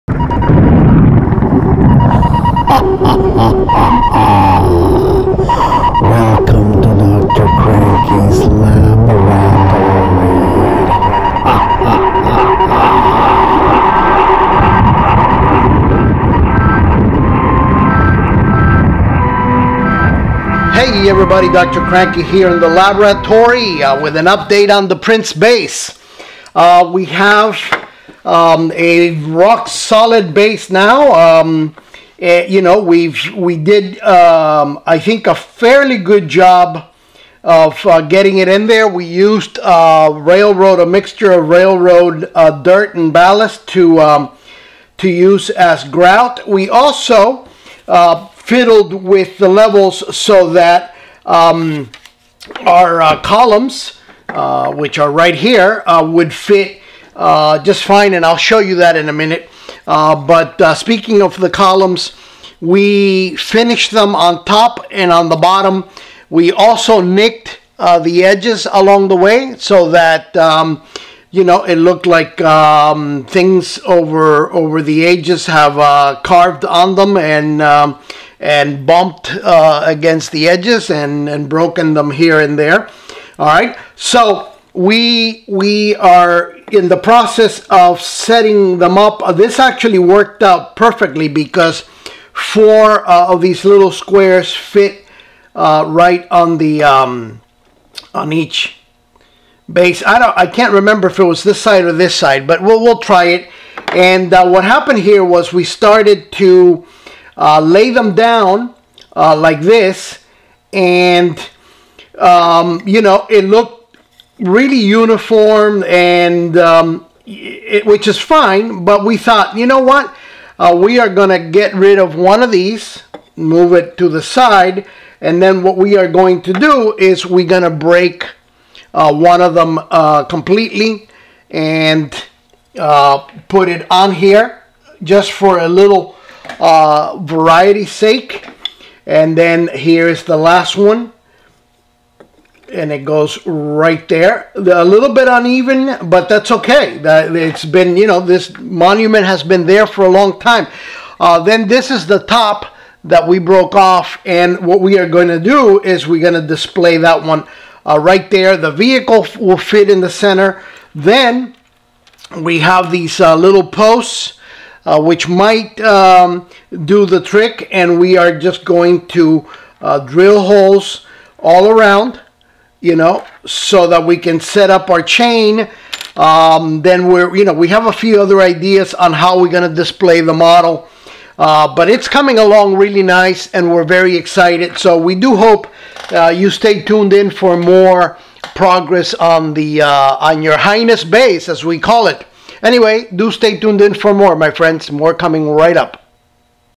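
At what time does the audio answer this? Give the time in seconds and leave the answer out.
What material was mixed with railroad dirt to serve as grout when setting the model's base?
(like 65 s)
43 s.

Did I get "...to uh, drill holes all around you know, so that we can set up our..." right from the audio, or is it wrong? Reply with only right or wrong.
right.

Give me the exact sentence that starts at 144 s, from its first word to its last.
A little bit uneven, but that's okay.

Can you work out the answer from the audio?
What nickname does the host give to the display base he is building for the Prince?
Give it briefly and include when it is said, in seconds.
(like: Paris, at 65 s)
Your Highness base, at 190 s.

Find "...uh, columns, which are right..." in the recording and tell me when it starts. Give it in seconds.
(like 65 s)
53 s.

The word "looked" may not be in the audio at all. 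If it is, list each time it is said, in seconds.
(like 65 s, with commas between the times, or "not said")
71 s, 113 s.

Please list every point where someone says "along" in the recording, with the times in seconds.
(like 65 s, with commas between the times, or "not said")
68 s, 182 s.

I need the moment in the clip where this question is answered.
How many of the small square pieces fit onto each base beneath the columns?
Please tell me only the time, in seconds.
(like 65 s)
92 s.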